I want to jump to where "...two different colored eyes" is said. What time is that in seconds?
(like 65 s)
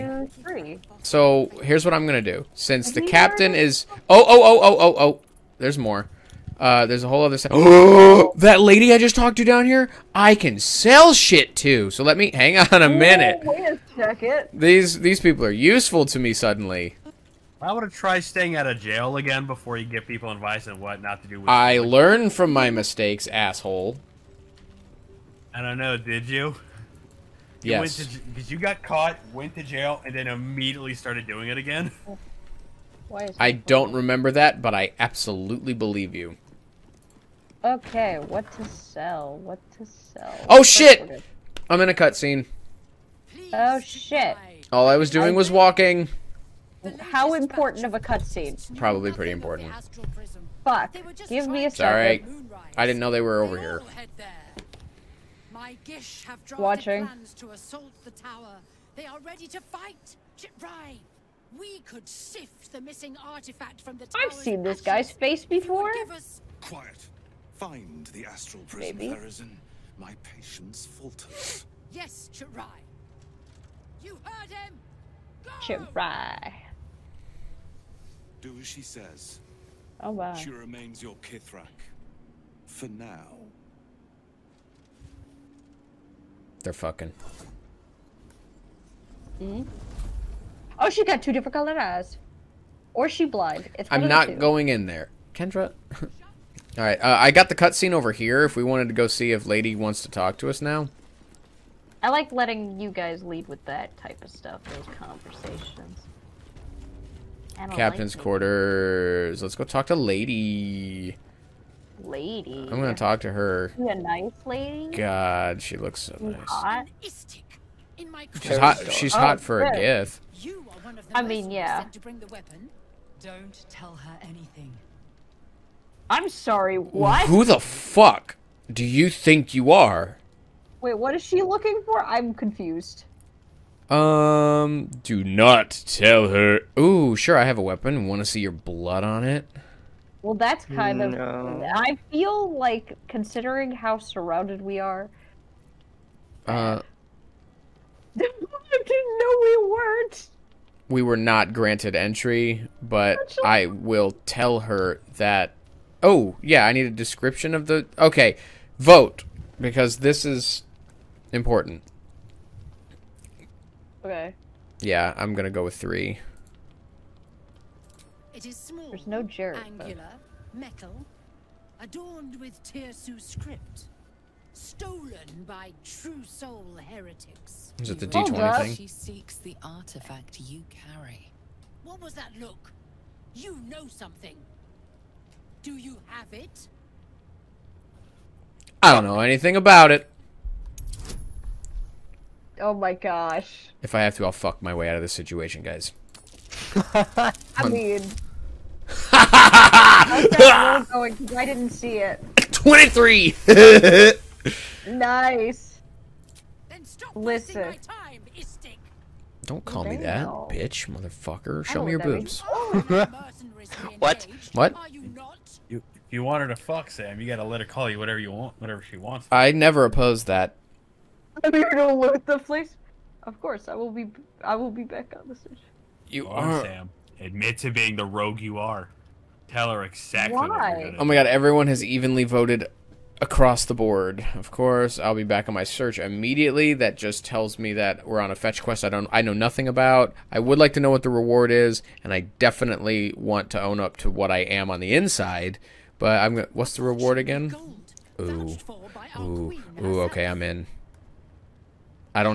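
91 s.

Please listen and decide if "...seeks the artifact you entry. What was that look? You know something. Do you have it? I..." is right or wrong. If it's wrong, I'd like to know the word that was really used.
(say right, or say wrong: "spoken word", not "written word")
wrong: "carry", not "entry".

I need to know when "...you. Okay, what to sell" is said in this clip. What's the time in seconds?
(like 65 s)
36 s.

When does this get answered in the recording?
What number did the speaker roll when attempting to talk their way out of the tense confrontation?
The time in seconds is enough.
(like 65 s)
202 s.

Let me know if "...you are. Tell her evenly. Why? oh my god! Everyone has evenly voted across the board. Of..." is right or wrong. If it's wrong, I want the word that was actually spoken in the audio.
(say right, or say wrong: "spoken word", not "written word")
wrong: "exactly", not "evenly".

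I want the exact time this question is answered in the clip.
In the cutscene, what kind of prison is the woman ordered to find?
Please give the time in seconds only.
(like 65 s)
68 s.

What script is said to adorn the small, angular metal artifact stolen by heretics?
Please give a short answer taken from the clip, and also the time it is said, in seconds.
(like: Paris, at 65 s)
Tir'su, at 172 s.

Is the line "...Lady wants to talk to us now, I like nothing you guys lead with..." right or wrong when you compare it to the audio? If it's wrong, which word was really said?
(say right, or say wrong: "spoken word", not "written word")
wrong: "letting", not "nothing".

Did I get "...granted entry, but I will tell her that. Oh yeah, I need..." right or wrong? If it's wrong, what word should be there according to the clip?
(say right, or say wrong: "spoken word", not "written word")
right.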